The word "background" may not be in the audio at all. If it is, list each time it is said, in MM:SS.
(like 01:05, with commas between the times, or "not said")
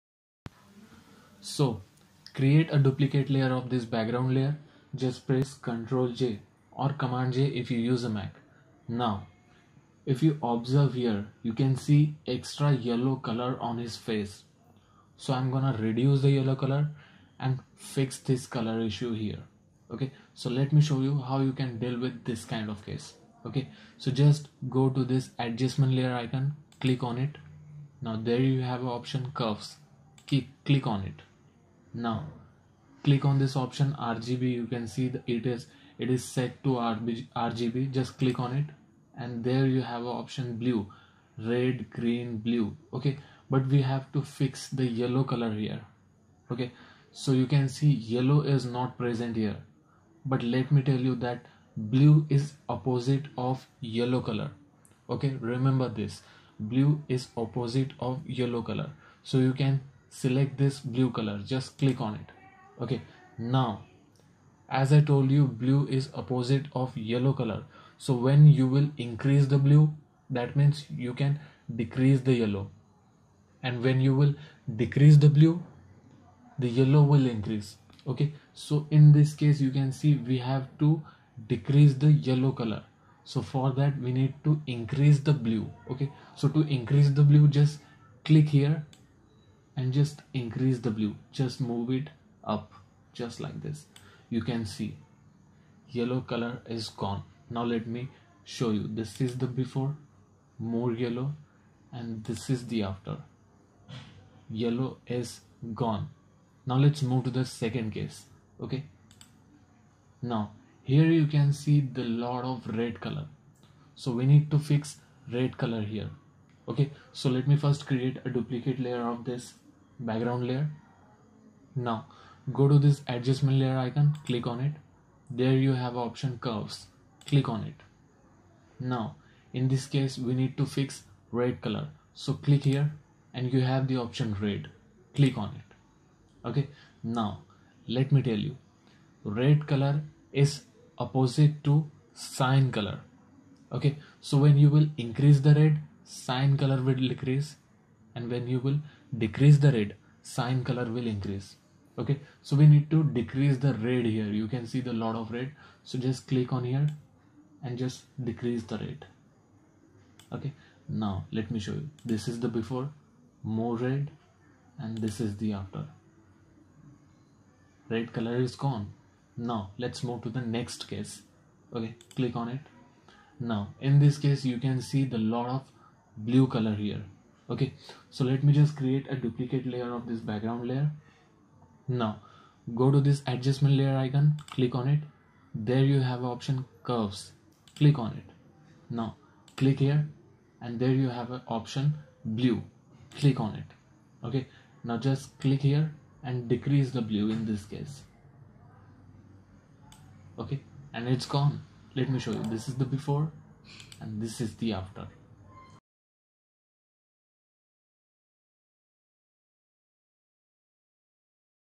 00:03, 01:59, 03:00.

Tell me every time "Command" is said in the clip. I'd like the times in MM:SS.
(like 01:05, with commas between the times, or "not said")
00:06.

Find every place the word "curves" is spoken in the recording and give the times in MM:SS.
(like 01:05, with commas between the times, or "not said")
00:29, 02:06, 03:06.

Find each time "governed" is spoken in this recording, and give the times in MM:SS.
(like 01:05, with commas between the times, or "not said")
not said.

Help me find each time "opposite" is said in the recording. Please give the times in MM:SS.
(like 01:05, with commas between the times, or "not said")
00:52, 00:57, 01:06, 02:20.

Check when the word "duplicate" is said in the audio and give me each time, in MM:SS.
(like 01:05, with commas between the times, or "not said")
00:02, 01:58, 02:59.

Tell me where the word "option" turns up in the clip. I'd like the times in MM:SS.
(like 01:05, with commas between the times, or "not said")
00:28, 00:33, 00:40, 02:05, 02:13, 03:06, 03:11.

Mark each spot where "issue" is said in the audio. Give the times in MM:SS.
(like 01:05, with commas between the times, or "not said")
00:18.